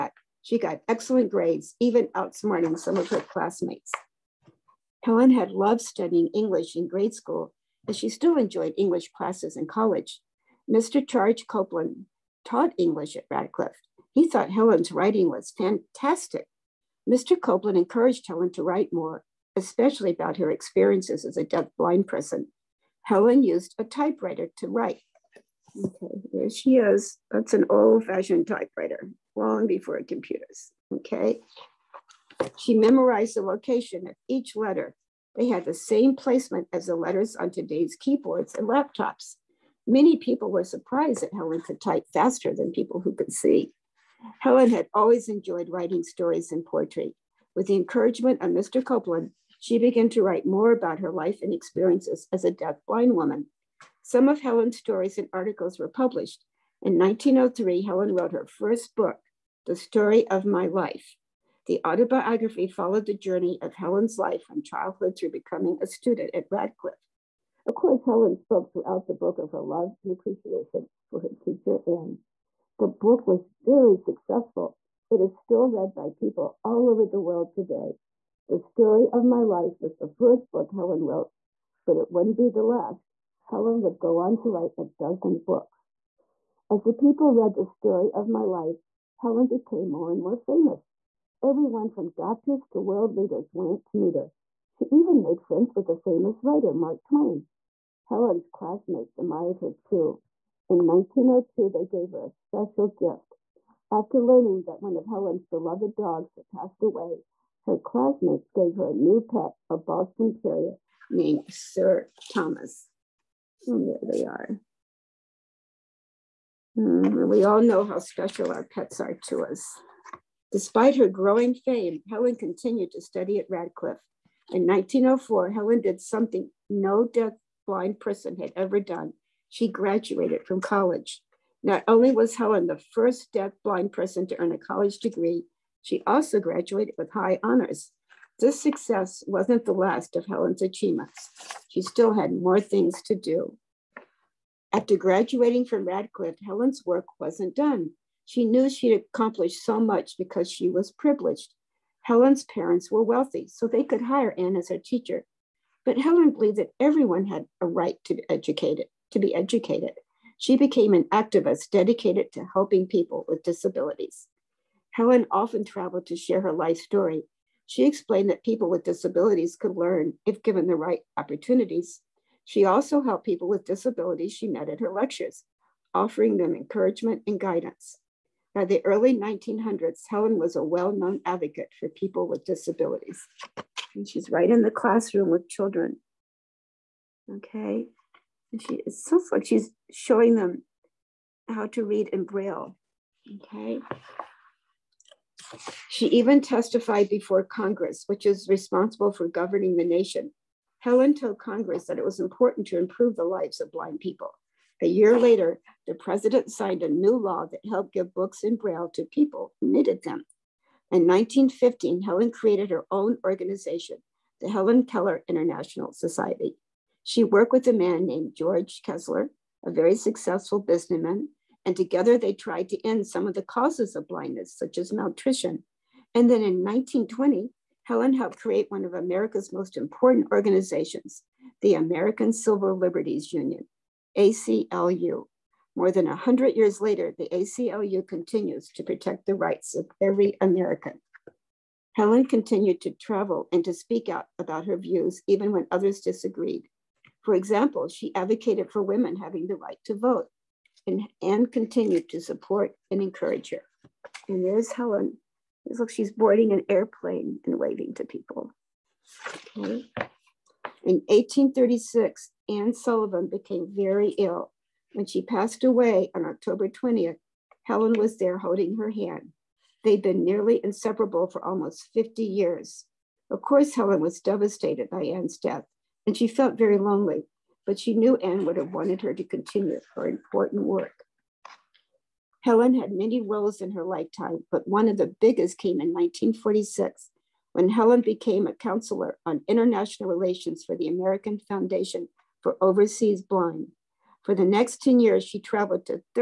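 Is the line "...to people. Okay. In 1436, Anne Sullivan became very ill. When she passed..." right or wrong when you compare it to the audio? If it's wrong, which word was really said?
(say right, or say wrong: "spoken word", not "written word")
wrong: "1836", not "1436".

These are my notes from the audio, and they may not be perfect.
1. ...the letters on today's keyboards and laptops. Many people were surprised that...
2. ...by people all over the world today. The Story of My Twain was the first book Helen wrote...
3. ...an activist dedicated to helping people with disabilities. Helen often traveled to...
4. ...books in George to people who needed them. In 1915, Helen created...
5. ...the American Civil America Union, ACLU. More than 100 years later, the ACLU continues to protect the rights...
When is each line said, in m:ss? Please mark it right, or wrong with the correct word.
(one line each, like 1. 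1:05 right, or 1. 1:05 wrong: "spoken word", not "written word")
1. 0:36 right
2. 1:15 wrong: "Life", not "Twain"
3. 2:40 right
4. 3:28 wrong: "Braille", not "George"
5. 3:51 wrong: "Liberties", not "America".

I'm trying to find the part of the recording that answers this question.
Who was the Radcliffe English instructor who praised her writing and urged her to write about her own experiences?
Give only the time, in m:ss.
0:11.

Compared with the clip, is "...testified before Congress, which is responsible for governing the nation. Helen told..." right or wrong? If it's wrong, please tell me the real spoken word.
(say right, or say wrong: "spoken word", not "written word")
right.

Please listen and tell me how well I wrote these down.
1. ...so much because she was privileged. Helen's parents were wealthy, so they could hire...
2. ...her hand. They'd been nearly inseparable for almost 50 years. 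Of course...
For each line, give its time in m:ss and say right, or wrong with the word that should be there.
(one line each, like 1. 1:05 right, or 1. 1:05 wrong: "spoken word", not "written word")
1. 2:29 right
2. 4:28 right.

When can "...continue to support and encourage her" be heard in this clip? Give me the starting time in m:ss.
4:11.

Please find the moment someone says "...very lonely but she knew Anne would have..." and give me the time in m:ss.
4:36.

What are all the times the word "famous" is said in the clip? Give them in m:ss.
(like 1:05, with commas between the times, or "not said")
1:30, 1:35.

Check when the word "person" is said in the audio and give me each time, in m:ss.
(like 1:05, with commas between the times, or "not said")
0:22, 2:07, 2:13.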